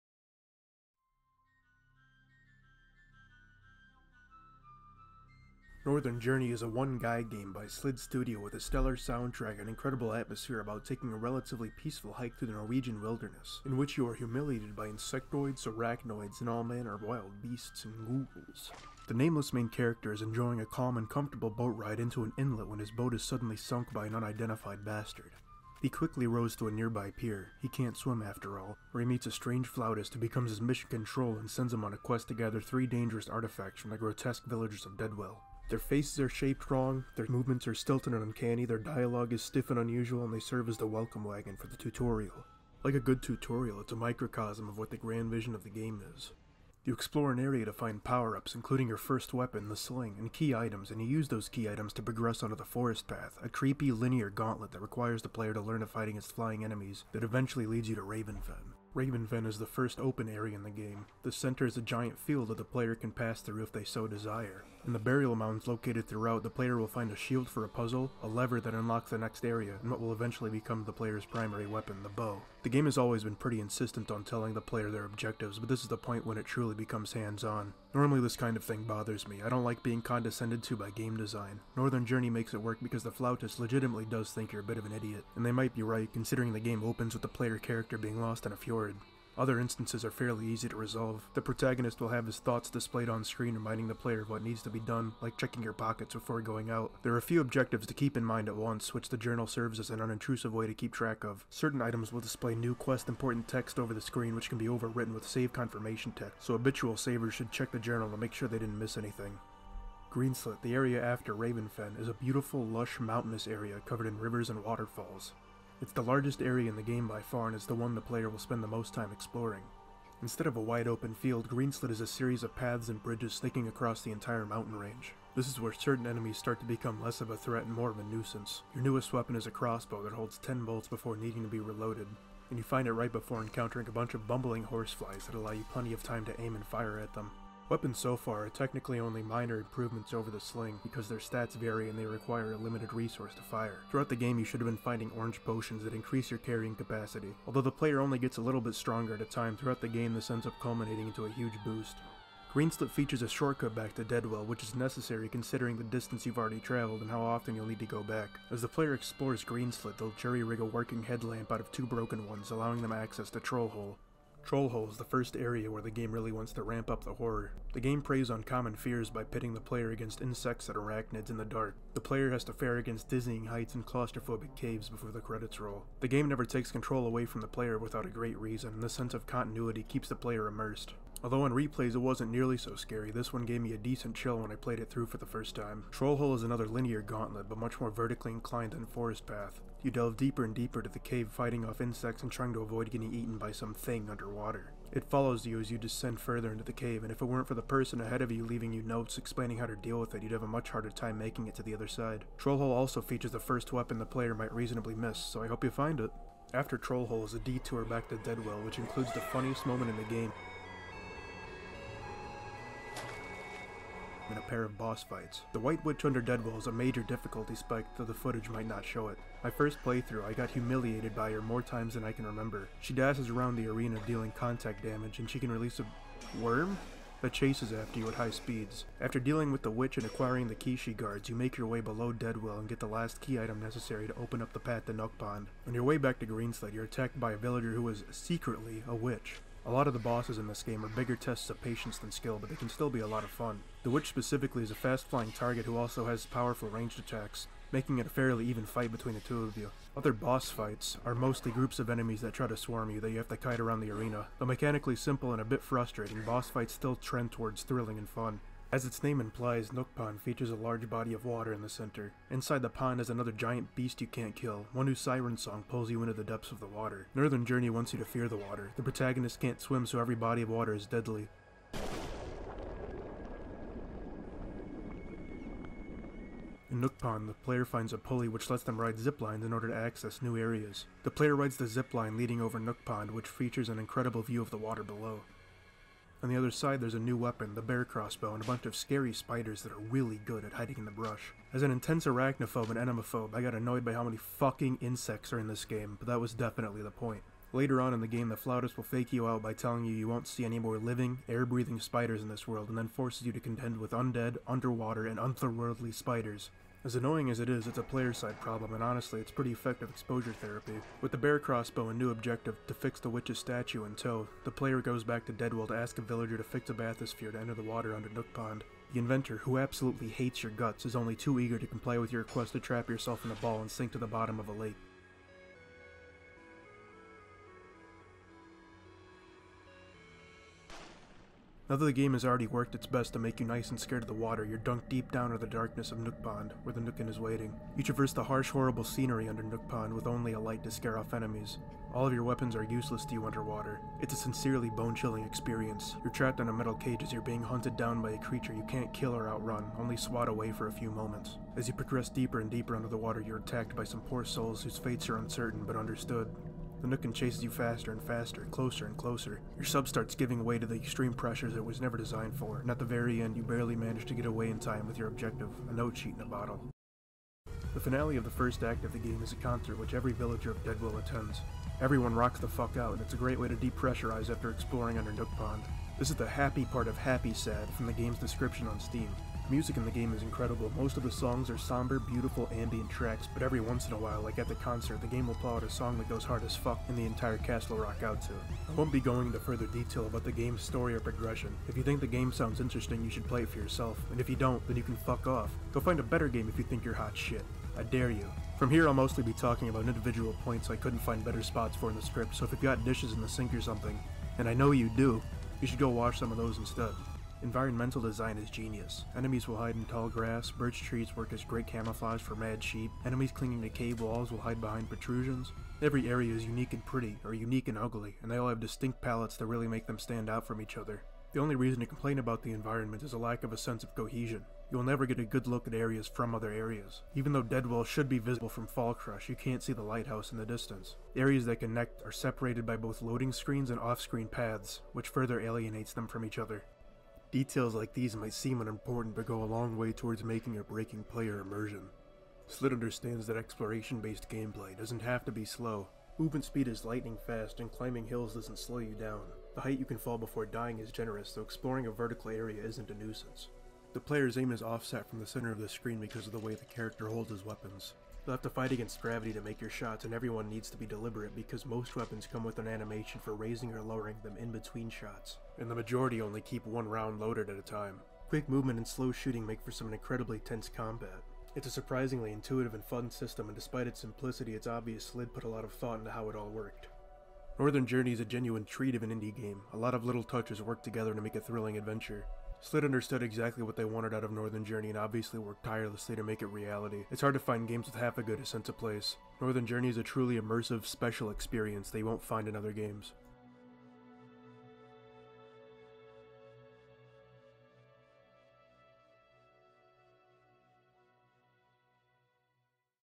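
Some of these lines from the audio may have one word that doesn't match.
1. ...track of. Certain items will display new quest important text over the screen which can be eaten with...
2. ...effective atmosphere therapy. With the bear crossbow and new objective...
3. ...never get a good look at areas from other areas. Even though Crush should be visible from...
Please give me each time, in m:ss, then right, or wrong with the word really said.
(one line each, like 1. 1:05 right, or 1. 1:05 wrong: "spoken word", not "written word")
1. 1:40 wrong: "overwritten", not "eaten"
2. 5:09 wrong: "exposure", not "atmosphere"
3. 7:04 wrong: "Deadwell", not "Crush".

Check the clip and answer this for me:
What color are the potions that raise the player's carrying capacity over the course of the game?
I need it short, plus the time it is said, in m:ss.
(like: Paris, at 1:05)
Orange, at 2:25.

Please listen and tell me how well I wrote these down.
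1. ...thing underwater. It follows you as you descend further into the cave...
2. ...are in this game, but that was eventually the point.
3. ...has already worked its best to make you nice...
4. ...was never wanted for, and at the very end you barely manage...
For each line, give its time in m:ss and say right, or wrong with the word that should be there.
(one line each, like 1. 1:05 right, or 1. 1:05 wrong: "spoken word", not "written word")
1. 3:13 right
2. 4:55 wrong: "definitely", not "eventually"
3. 5:32 right
4. 6:01 wrong: "designed", not "wanted".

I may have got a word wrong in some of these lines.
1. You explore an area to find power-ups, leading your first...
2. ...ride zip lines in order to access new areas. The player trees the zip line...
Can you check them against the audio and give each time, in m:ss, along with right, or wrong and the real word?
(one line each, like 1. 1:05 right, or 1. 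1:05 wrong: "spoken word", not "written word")
1. 0:46 wrong: "including", not "leading"
2. 4:38 wrong: "rides", not "trees".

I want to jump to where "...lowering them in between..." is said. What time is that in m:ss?
7:43.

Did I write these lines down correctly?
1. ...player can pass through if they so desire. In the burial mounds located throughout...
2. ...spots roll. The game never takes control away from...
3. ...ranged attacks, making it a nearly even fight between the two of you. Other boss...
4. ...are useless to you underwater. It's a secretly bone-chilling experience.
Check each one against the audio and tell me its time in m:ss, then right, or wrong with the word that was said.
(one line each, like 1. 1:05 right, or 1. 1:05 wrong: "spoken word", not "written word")
1. 1:02 right
2. 2:55 wrong: "credits", not "spots"
3. 4:06 wrong: "fairly", not "nearly"
4. 5:42 wrong: "sincerely", not "secretly".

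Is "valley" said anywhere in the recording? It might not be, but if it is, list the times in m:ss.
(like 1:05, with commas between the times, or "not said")
not said.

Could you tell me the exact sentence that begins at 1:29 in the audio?
Other instances are fairly easy to resolve.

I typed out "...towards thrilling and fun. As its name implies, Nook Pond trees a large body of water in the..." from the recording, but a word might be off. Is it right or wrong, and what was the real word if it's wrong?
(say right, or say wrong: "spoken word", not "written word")
wrong: "features", not "trees".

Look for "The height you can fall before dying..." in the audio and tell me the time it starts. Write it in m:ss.
7:29.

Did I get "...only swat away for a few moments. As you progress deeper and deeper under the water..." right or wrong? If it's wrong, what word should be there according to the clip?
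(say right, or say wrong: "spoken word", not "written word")
right.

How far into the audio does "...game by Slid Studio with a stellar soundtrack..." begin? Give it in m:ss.
0:07.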